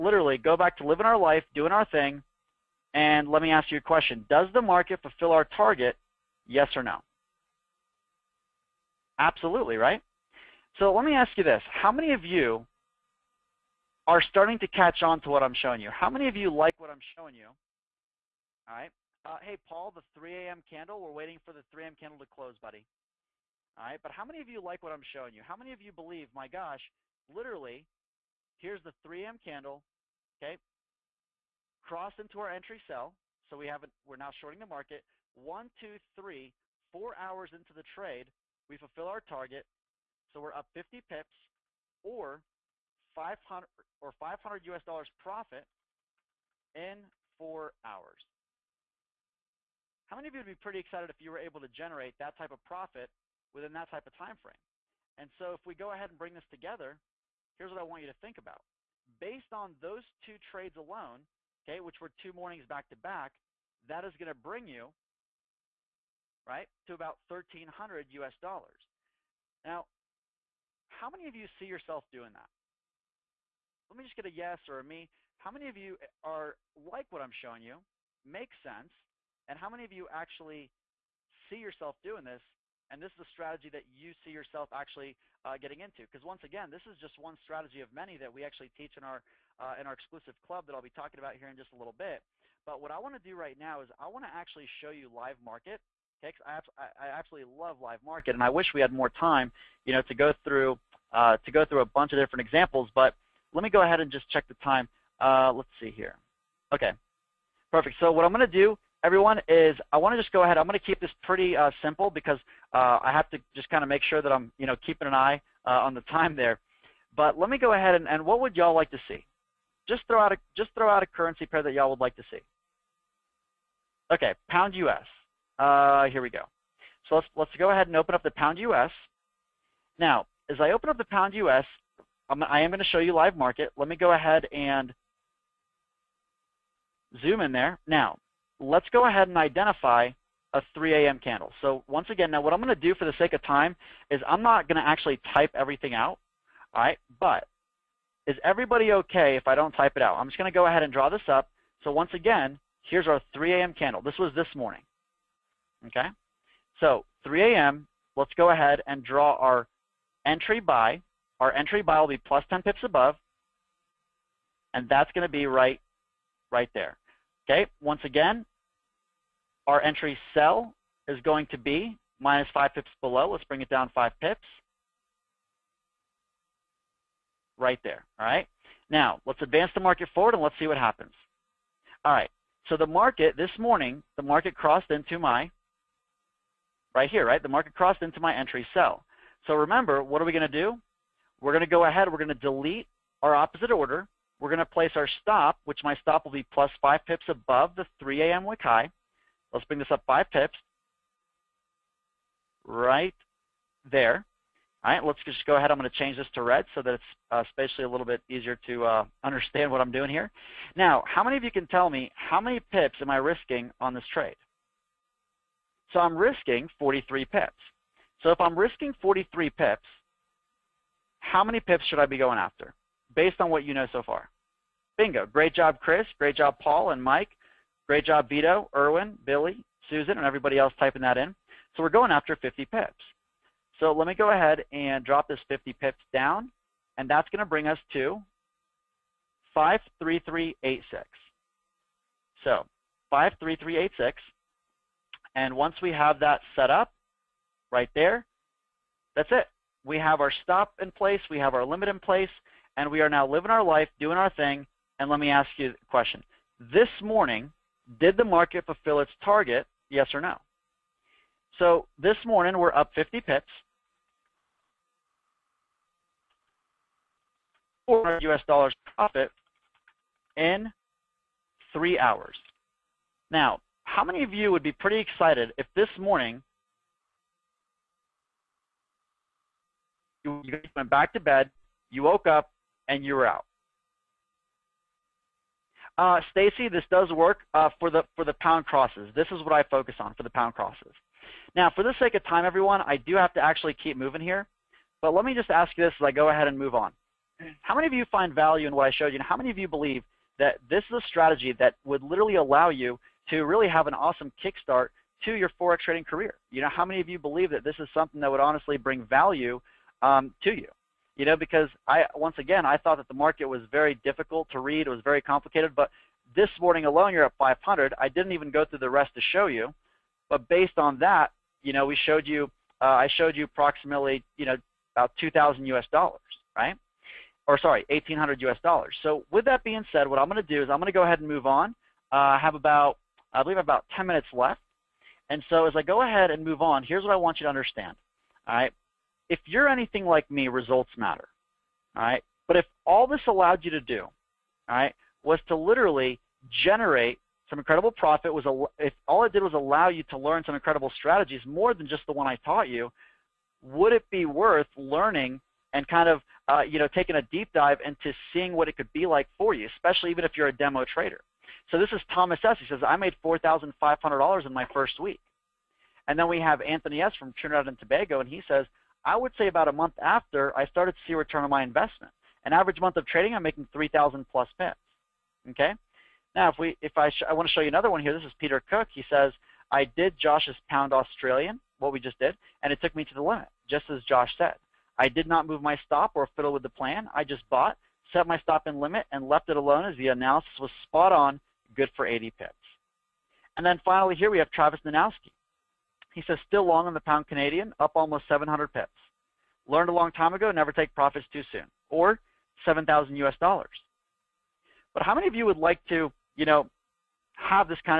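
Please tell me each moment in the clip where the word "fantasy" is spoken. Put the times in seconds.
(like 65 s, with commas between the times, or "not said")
not said.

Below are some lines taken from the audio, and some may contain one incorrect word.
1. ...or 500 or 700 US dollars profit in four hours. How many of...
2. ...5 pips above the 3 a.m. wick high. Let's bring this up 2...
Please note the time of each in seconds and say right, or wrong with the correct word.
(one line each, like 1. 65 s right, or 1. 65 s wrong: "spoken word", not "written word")
1. 42 s wrong: "500", not "700"
2. 196 s wrong: "5", not "2".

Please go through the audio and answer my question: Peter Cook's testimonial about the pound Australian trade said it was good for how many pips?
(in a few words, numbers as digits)
80 pips.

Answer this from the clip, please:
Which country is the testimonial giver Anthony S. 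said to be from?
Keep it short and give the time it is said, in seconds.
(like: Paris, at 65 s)
Trinidad and Tobago, at 367 s.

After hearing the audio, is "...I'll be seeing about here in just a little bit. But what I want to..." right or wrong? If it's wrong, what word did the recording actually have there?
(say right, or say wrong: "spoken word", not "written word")
wrong: "talking", not "seeing".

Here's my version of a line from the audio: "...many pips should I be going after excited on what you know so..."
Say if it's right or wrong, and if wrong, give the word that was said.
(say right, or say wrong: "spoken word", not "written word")
wrong: "based", not "excited".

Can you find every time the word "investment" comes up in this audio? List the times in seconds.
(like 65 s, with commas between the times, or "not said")
371 s.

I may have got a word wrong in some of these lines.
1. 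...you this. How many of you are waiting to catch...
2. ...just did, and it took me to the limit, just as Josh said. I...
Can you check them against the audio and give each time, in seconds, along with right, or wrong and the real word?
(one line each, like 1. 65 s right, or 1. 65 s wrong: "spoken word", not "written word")
1. 11 s wrong: "starting", not "waiting"
2. 381 s right.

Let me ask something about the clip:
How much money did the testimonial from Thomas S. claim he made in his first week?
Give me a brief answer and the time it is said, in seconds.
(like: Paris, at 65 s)
$4,500, at 363 s.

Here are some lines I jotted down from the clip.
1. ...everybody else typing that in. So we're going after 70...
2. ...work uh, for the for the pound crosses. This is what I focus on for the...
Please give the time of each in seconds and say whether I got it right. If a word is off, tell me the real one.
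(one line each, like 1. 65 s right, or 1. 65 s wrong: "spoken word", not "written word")
1. 230 s wrong: "50", not "70"
2. 287 s right.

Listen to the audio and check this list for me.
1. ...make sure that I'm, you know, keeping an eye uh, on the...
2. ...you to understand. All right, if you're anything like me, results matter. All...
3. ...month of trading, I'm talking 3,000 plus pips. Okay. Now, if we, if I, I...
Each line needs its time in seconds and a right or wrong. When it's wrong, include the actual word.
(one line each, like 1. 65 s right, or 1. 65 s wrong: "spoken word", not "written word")
1. 113 s right
2. 337 s right
3. 372 s wrong: "making", not "talking".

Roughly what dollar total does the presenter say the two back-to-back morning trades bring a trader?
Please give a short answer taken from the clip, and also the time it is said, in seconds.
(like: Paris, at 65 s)
1300 US dollars, at 67 s.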